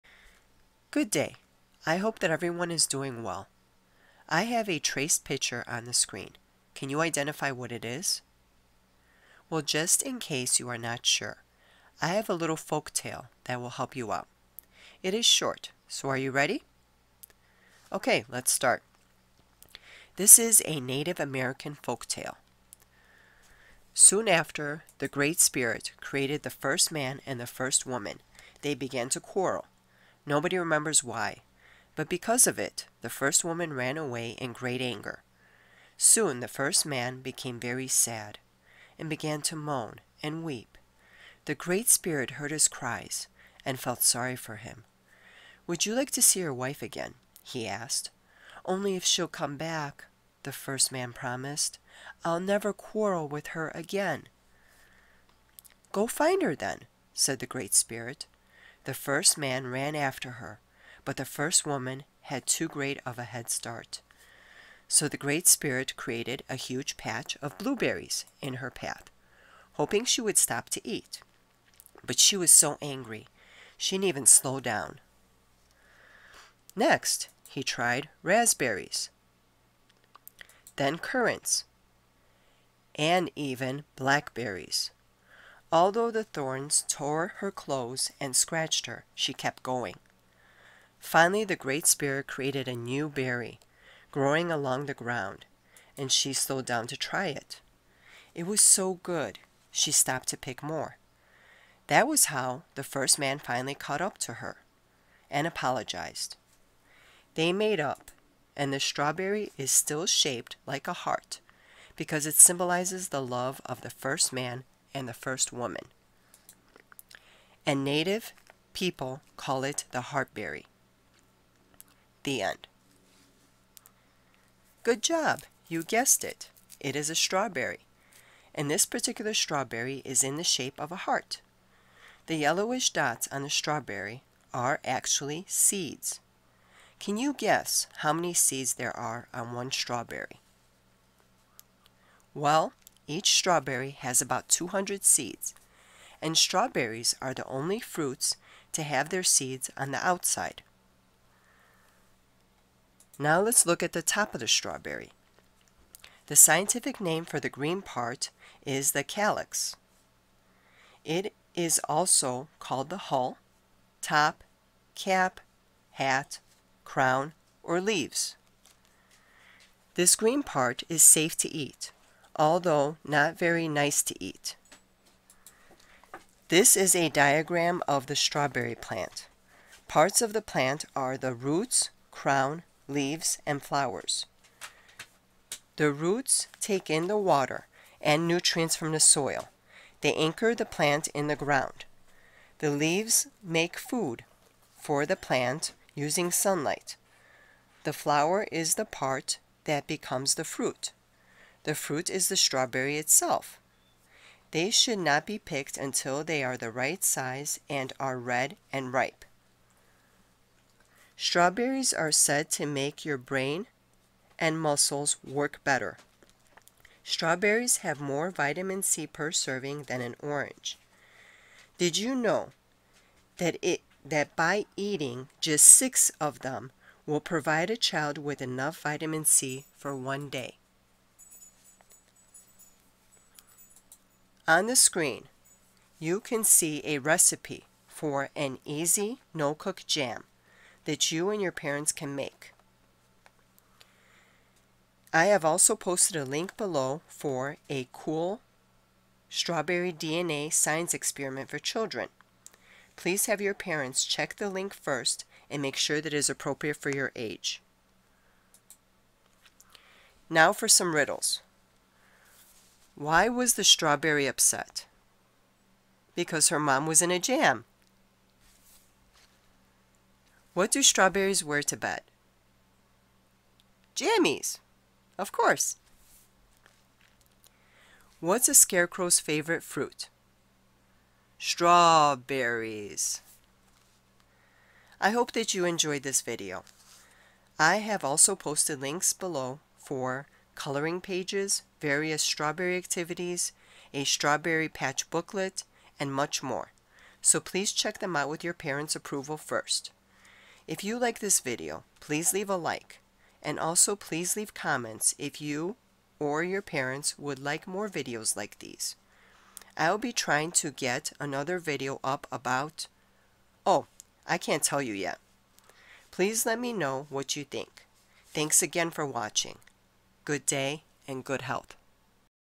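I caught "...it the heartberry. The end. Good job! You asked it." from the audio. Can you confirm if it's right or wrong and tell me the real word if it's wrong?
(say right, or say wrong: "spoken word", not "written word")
wrong: "guessed", not "asked".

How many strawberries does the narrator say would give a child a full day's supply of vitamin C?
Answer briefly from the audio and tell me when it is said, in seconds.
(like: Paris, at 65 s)
6, at 225 s.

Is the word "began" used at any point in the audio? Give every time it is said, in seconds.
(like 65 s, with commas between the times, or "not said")
28 s, 39 s.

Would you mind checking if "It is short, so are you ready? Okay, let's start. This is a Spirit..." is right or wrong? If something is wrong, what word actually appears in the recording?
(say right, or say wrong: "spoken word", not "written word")
wrong: "Native", not "Spirit".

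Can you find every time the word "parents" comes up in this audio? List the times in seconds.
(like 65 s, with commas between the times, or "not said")
241 s, 253 s, 298 s, 306 s.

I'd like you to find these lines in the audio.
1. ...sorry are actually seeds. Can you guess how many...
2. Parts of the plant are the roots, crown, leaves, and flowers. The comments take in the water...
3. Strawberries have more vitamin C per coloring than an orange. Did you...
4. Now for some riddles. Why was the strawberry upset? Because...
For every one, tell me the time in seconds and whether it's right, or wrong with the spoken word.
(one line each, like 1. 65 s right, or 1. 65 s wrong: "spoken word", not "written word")
1. 133 s wrong: "strawberry", not "sorry"
2. 179 s wrong: "roots", not "comments"
3. 217 s wrong: "serving", not "coloring"
4. 260 s right.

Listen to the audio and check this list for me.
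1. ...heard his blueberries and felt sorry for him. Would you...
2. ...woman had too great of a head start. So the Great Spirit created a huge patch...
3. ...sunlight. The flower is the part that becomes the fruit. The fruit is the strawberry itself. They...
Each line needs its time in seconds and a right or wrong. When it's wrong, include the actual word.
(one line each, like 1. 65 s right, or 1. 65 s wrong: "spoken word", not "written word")
1. 42 s wrong: "cries", not "blueberries"
2. 61 s right
3. 196 s right.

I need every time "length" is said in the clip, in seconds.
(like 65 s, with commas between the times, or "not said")
not said.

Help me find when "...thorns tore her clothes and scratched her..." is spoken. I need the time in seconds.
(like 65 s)
86 s.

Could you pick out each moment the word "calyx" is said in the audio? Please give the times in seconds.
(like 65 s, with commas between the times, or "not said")
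159 s.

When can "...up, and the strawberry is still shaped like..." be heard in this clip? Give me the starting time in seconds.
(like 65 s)
107 s.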